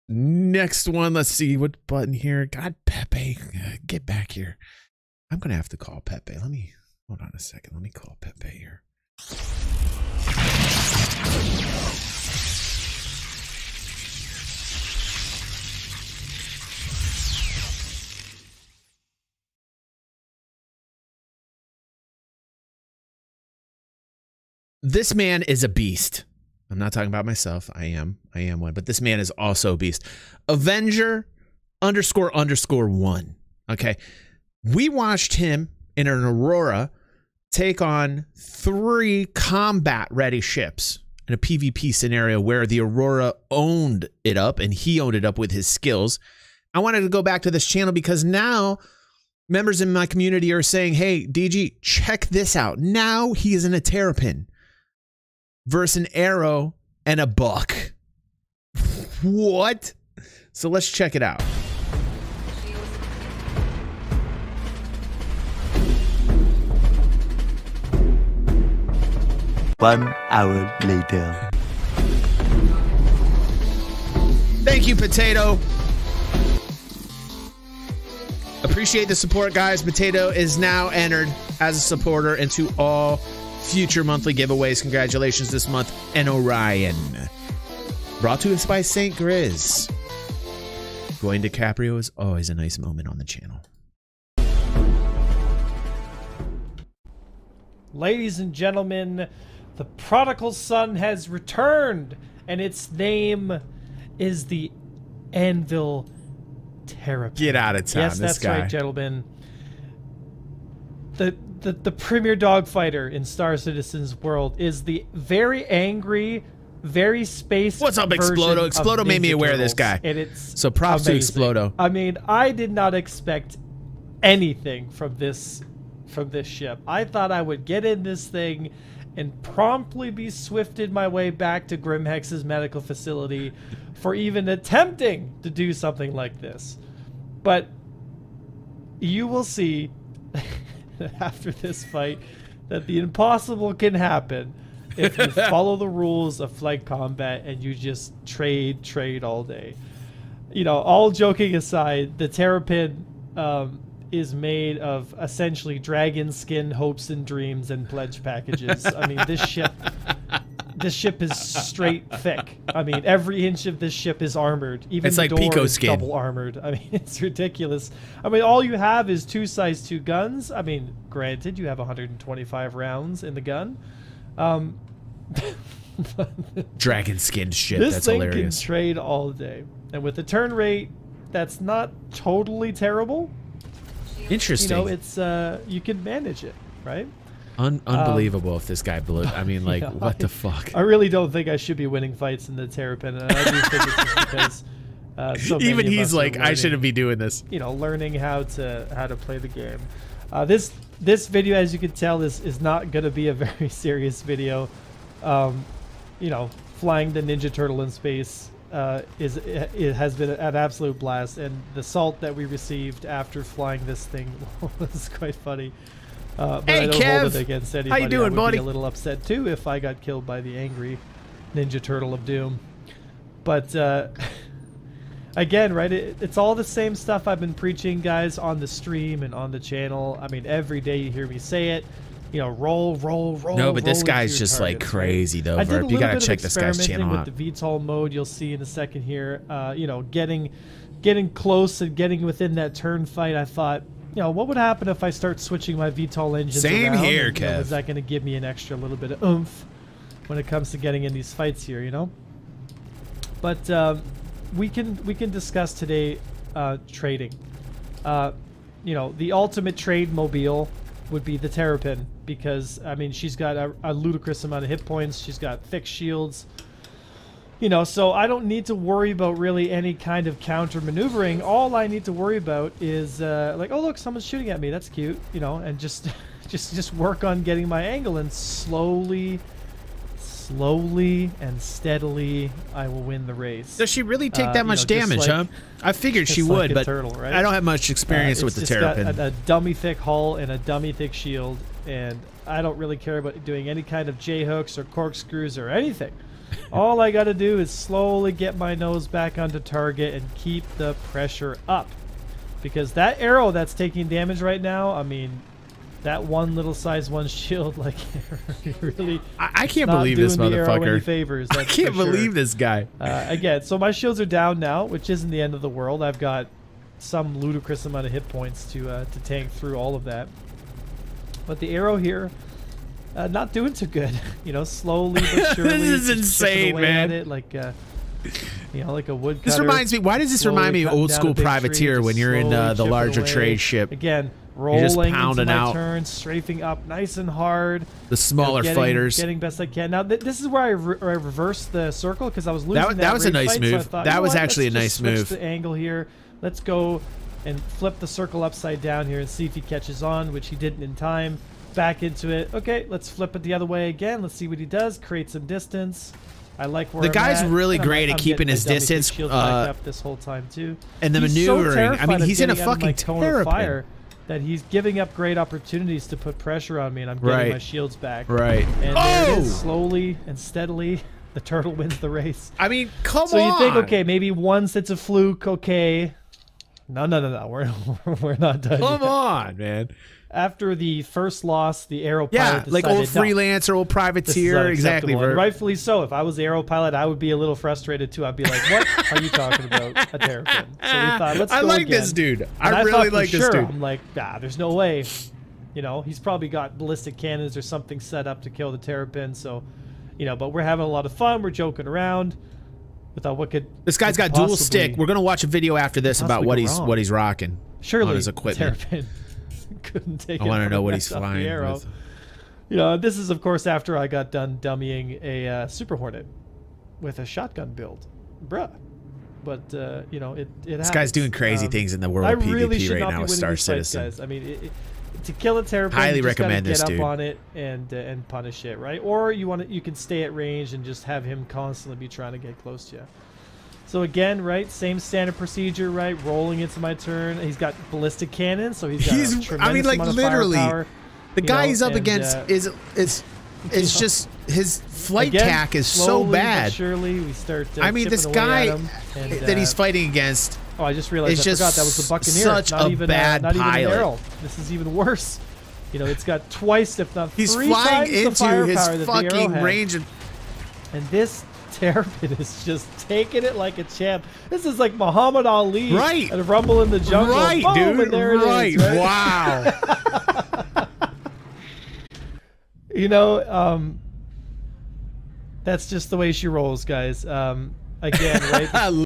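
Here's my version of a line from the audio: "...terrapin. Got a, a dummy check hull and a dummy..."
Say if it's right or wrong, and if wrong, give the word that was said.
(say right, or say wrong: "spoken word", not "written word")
wrong: "thick", not "check".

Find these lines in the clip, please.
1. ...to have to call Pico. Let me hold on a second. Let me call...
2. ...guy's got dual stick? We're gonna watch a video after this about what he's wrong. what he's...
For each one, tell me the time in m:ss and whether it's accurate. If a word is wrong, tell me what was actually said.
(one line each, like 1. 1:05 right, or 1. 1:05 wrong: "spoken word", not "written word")
1. 0:05 wrong: "Pepe", not "Pico"
2. 6:43 right.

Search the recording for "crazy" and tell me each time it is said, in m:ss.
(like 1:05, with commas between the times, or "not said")
3:54, 7:01.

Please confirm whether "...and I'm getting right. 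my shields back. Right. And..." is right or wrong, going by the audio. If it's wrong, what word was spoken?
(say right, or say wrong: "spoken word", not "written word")
right.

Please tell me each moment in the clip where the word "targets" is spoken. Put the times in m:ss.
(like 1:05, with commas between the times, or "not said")
3:54, 4:59.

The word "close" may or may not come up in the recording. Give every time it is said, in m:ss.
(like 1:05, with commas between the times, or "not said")
4:01, 7:12.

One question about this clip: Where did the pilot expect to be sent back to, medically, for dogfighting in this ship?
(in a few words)
Grimhex.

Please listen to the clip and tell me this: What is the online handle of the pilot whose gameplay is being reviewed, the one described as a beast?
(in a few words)
Avenger__1.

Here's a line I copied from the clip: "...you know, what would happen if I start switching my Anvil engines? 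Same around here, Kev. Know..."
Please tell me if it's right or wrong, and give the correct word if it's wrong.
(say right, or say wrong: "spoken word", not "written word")
wrong: "VTOL", not "Anvil".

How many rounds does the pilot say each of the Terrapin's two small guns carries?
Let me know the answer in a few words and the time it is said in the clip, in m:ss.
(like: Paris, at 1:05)
125, at 2:51.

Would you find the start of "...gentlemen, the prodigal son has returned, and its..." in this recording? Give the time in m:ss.
1:38.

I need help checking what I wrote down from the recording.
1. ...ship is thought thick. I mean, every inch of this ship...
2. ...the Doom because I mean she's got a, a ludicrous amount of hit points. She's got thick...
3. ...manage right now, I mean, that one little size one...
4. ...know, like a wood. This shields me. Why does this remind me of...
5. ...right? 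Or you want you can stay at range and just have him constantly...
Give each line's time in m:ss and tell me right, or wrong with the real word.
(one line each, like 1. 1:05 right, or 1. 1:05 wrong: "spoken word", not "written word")
1. 2:40 wrong: "straight", not "thought"
2. 4:21 wrong: "Terrapin", not "Doom"
3. 5:04 wrong: "damage", not "manage"
4. 5:28 wrong: "reminds", not "shields"
5. 7:08 right.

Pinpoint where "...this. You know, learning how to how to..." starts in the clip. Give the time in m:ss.
3:17.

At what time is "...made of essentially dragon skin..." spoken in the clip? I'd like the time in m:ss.
2:34.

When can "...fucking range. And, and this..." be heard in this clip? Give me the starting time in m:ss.
7:39.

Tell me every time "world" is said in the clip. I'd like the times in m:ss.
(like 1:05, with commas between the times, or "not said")
1:54, 5:15, 7:02.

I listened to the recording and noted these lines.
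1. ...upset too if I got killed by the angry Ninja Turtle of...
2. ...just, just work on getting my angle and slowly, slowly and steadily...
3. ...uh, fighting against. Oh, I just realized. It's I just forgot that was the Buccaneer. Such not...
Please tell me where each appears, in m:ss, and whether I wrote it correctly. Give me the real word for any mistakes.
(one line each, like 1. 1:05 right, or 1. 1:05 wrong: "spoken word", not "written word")
1. 3:38 right
2. 4:36 right
3. 7:29 right.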